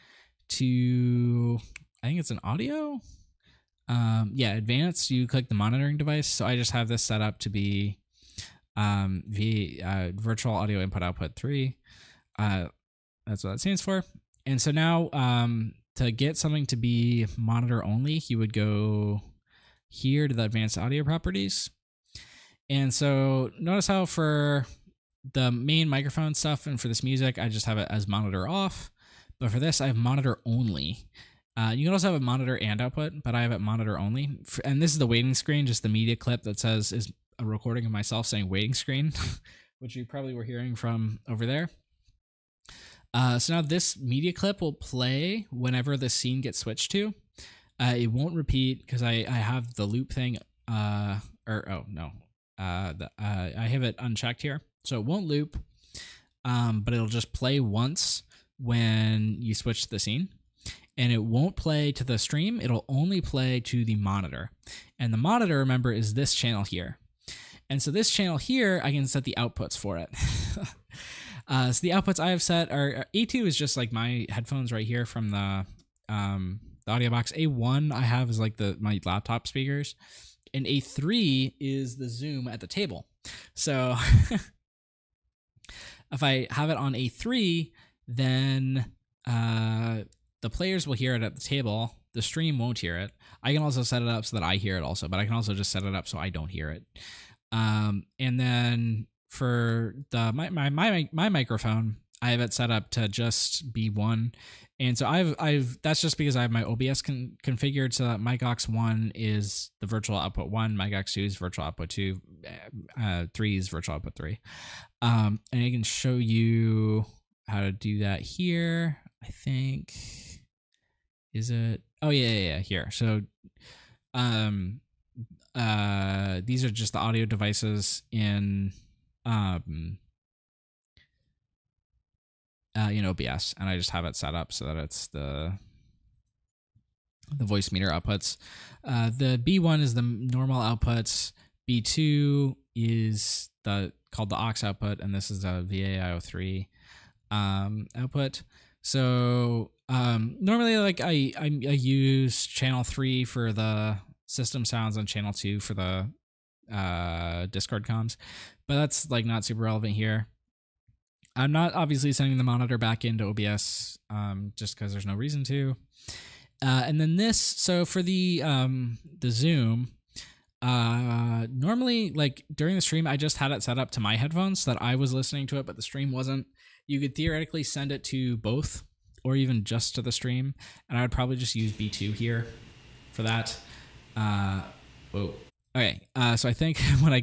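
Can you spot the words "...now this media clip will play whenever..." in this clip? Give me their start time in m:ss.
0:43.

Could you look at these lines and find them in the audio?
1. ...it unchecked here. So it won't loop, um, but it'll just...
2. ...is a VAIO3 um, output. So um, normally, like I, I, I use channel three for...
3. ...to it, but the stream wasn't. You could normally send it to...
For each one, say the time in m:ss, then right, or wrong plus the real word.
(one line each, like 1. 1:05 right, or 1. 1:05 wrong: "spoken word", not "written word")
1. 0:53 right
2. 2:25 right
3. 2:55 wrong: "theoretically", not "normally".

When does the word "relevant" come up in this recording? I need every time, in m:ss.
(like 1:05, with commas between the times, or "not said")
2:39.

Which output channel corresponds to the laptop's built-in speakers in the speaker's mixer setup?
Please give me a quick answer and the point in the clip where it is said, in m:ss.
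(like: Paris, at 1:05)
A1, at 1:17.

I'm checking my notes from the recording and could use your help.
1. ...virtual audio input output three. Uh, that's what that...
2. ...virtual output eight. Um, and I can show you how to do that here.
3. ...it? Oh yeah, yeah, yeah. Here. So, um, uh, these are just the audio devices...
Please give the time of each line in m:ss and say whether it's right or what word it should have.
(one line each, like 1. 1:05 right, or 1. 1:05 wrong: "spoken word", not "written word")
1. 0:10 right
2. 1:53 wrong: "three", not "eight"
3. 2:01 right.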